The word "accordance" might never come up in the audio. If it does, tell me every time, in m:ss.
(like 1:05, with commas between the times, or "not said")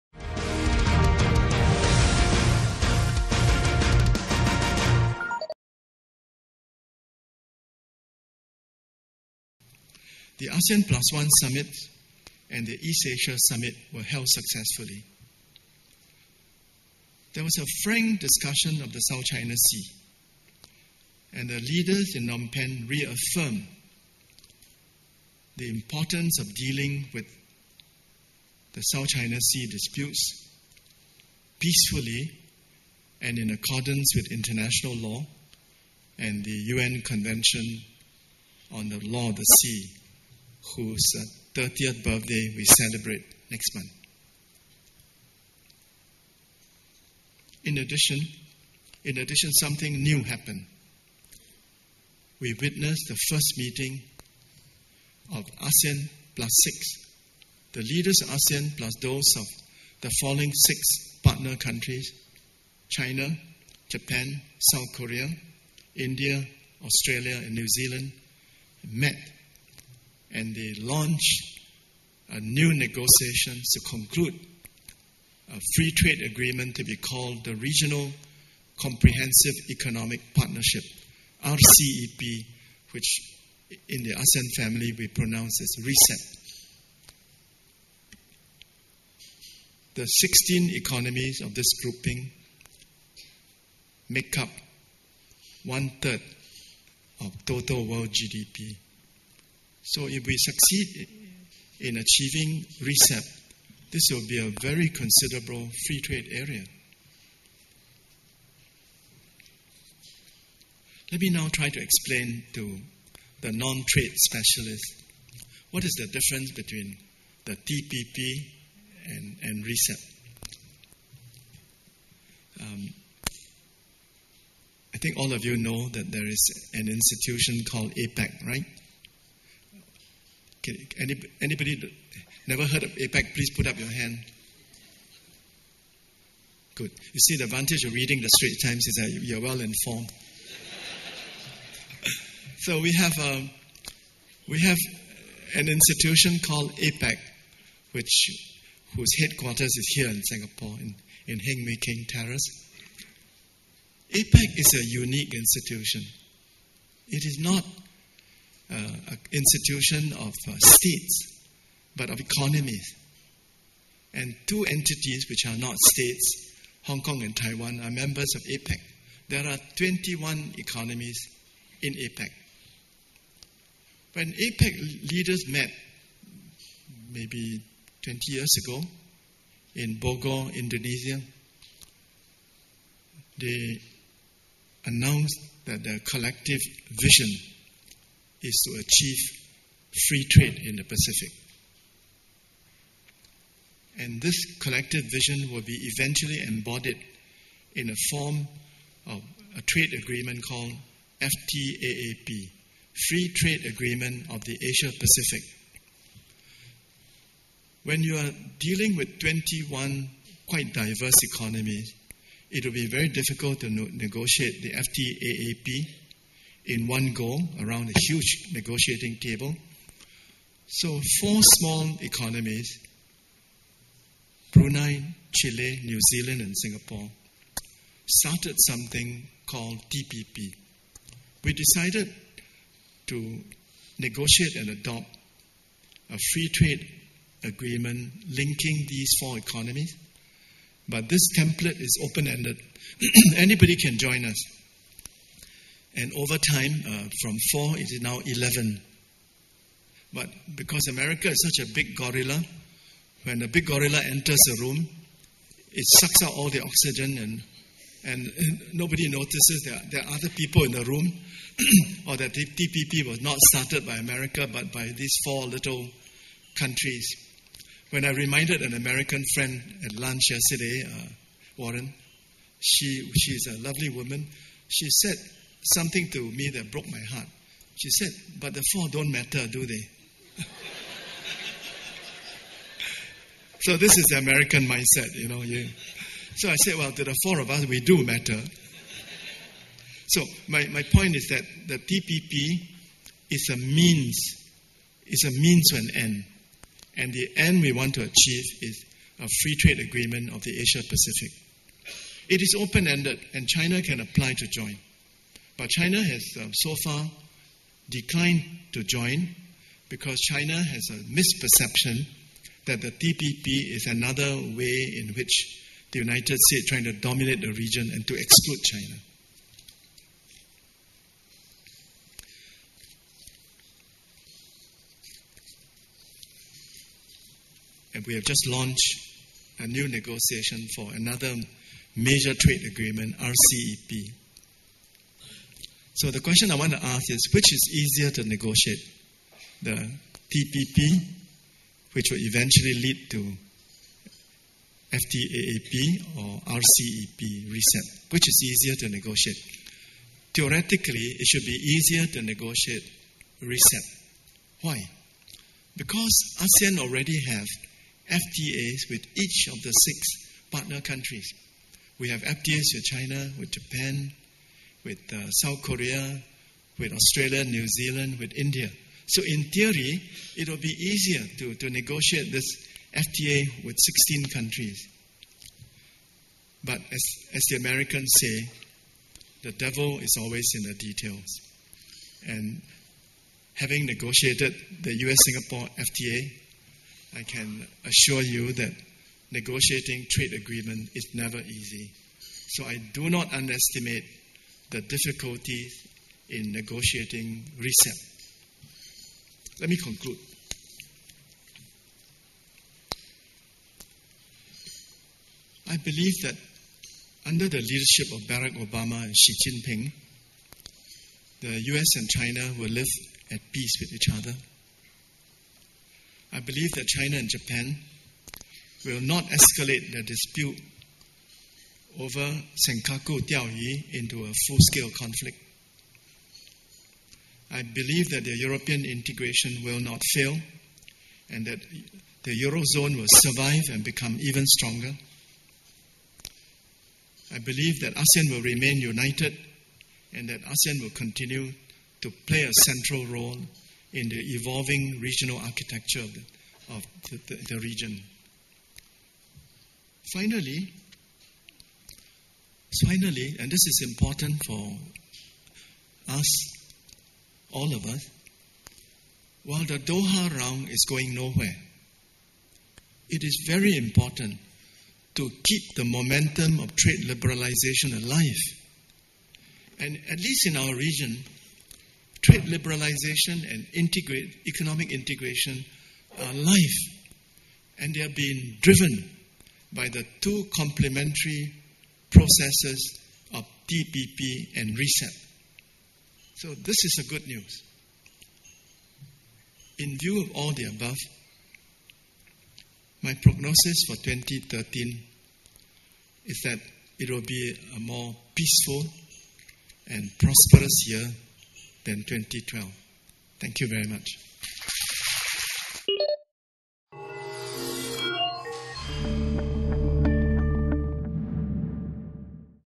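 0:33.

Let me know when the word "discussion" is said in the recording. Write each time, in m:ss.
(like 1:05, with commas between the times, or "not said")
0:18.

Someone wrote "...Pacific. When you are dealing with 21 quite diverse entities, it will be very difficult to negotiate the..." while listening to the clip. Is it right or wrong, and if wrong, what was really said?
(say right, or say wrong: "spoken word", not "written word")
wrong: "economies", not "entities".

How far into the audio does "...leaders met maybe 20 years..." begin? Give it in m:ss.
2:55.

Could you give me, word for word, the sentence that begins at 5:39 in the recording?
The TPP, which will eventually lead to FTAAP or RCEP, reset?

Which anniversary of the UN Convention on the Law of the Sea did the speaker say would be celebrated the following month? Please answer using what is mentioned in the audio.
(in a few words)
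30th.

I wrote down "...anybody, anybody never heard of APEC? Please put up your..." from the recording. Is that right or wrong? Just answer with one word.
right.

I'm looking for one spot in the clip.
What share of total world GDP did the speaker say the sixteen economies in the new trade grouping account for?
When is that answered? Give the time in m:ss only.
1:35.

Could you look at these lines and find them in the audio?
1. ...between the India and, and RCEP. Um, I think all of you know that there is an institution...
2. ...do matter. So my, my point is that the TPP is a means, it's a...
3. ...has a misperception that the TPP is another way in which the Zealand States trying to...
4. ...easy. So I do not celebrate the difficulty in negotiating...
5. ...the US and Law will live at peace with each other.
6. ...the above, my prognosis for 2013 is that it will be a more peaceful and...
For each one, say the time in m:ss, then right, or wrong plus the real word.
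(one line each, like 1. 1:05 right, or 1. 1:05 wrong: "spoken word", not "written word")
1. 1:56 wrong: "TPP", not "India"
2. 4:47 right
3. 5:10 wrong: "United", not "Zealand"
4. 6:31 wrong: "underestimate", not "celebrate"
5. 6:51 wrong: "China", not "Law"
6. 8:10 right.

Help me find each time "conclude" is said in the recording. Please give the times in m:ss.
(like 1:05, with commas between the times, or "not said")
1:13, 6:39.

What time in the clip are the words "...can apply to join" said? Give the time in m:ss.
5:03.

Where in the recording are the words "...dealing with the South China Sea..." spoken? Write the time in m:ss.
0:26.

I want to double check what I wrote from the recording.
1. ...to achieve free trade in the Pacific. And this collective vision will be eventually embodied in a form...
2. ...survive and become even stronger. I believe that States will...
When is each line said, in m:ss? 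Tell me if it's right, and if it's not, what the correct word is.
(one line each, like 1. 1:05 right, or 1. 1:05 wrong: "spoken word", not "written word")
1. 3:08 right
2. 7:13 wrong: "ASEAN", not "States".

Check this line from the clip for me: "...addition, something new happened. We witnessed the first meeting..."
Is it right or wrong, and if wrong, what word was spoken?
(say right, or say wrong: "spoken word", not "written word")
right.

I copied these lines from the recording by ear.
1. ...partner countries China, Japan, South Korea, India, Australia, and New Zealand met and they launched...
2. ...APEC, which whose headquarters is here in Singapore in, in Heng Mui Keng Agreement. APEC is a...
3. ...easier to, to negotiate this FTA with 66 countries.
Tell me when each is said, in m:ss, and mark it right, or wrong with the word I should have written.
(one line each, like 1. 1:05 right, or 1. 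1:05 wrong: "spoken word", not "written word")
1. 1:01 right
2. 2:26 wrong: "Terrace", not "Agreement"
3. 6:10 wrong: "16", not "66".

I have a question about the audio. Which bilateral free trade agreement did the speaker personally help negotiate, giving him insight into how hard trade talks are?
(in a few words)
US Singapore FTA.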